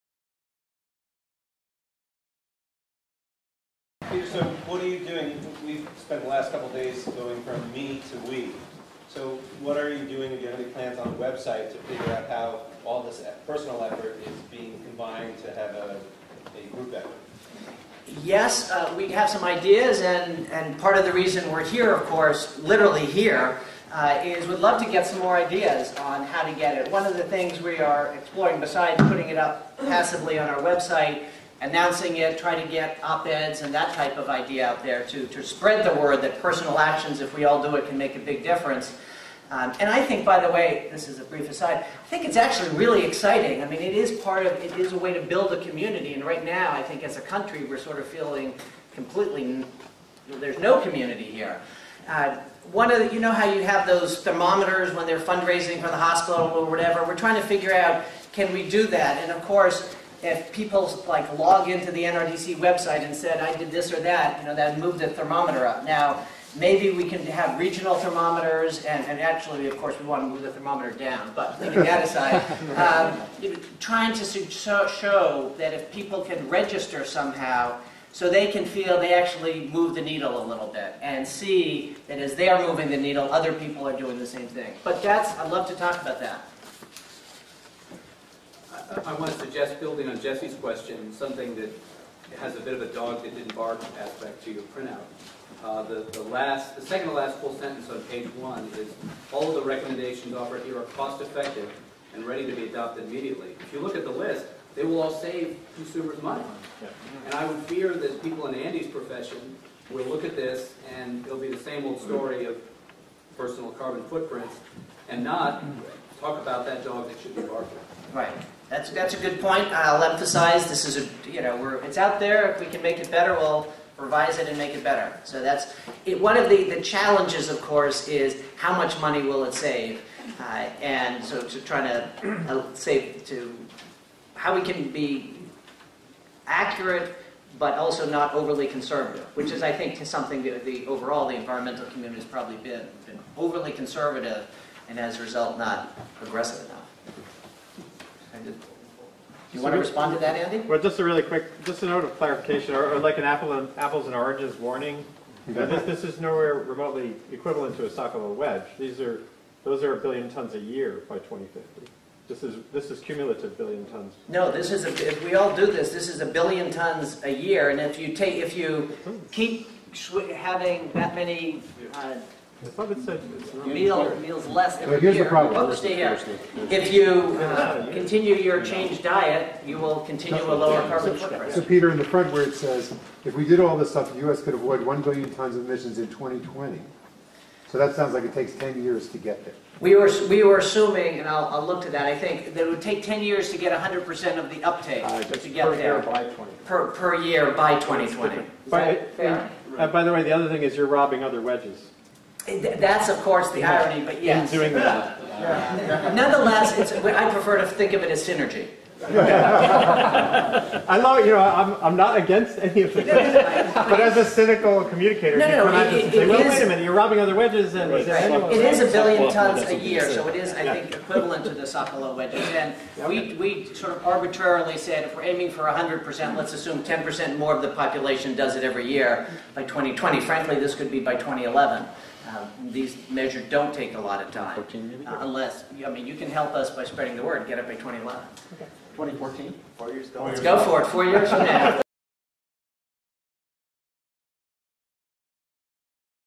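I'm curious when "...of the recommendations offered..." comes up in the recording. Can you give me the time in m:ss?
1:39.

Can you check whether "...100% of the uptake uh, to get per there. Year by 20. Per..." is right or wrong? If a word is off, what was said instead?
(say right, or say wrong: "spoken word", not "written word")
right.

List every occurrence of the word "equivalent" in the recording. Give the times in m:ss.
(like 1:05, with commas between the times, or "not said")
2:37, 3:40.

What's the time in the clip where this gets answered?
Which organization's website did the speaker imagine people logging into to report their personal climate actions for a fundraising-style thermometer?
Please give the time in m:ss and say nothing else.
1:02.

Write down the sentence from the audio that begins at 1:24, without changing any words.
But that's, I'd love to talk about that.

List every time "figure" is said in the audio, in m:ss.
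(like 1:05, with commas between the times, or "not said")
0:11, 0:57.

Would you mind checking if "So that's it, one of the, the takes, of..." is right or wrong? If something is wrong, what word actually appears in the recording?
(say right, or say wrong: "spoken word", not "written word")
wrong: "challenges", not "takes".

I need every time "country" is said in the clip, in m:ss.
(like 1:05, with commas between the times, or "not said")
0:47.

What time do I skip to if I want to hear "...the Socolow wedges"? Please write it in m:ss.
3:41.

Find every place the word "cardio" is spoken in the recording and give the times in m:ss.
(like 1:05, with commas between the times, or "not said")
not said.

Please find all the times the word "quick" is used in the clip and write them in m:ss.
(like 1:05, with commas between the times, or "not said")
2:31.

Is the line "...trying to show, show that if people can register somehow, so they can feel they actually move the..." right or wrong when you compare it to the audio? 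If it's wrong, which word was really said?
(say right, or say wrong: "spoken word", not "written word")
right.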